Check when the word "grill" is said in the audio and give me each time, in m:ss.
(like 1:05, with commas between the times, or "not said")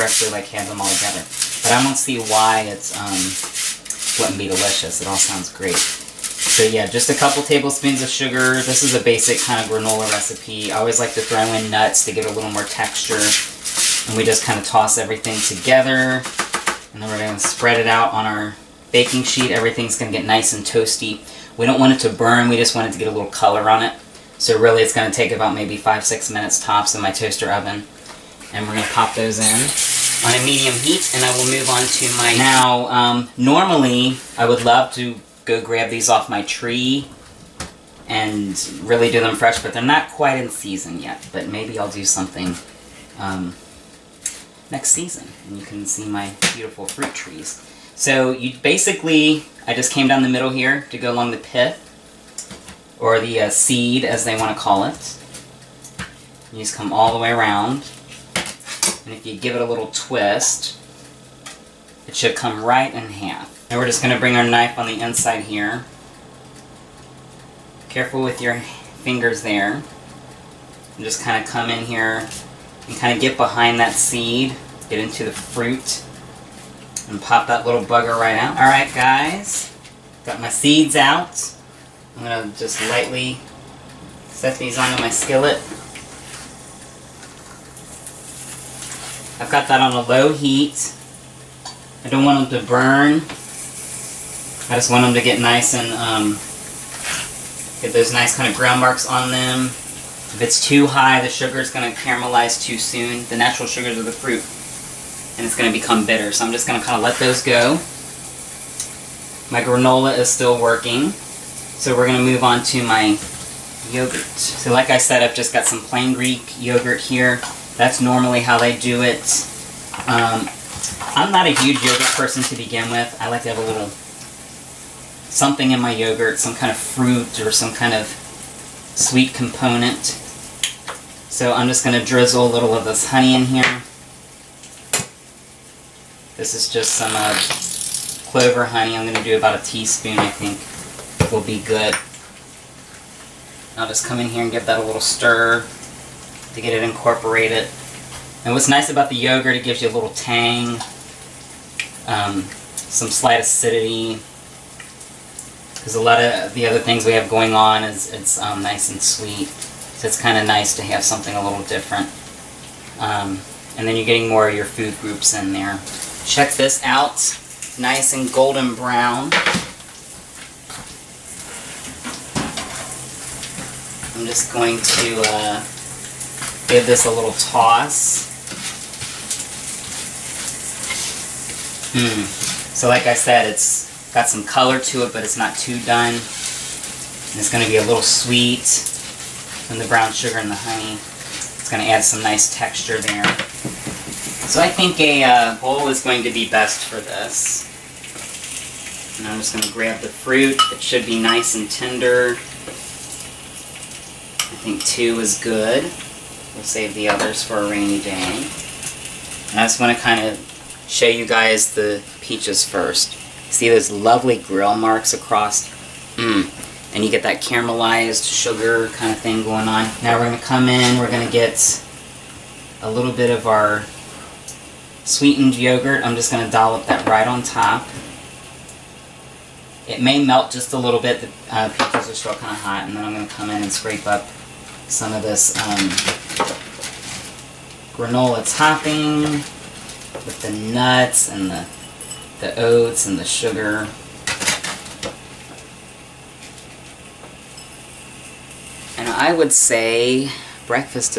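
3:34.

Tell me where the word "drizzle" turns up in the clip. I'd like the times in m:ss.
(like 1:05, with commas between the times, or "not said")
2:12.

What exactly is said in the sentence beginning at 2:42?
Um, and then you're getting more of your food groups in there.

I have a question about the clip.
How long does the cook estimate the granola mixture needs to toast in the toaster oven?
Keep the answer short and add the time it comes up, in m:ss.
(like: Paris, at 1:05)
5 to 6 minutes, at 0:25.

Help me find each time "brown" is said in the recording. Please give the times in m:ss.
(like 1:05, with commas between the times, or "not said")
2:48, 3:09.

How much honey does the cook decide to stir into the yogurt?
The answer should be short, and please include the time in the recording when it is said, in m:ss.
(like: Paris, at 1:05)
1 teaspoon, at 2:19.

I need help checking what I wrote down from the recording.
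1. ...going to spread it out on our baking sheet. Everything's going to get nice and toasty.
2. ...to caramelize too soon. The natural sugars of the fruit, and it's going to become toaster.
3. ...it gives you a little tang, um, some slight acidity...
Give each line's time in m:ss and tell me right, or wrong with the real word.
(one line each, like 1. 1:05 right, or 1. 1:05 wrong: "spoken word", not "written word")
1. 0:17 right
2. 1:41 wrong: "bitter", not "toaster"
3. 2:29 right.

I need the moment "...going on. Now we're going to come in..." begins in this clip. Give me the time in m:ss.
3:39.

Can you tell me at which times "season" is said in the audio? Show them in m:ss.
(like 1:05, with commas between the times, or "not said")
0:40, 0:44.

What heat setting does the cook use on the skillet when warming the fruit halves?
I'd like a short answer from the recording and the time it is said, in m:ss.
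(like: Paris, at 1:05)
low heat, at 1:30.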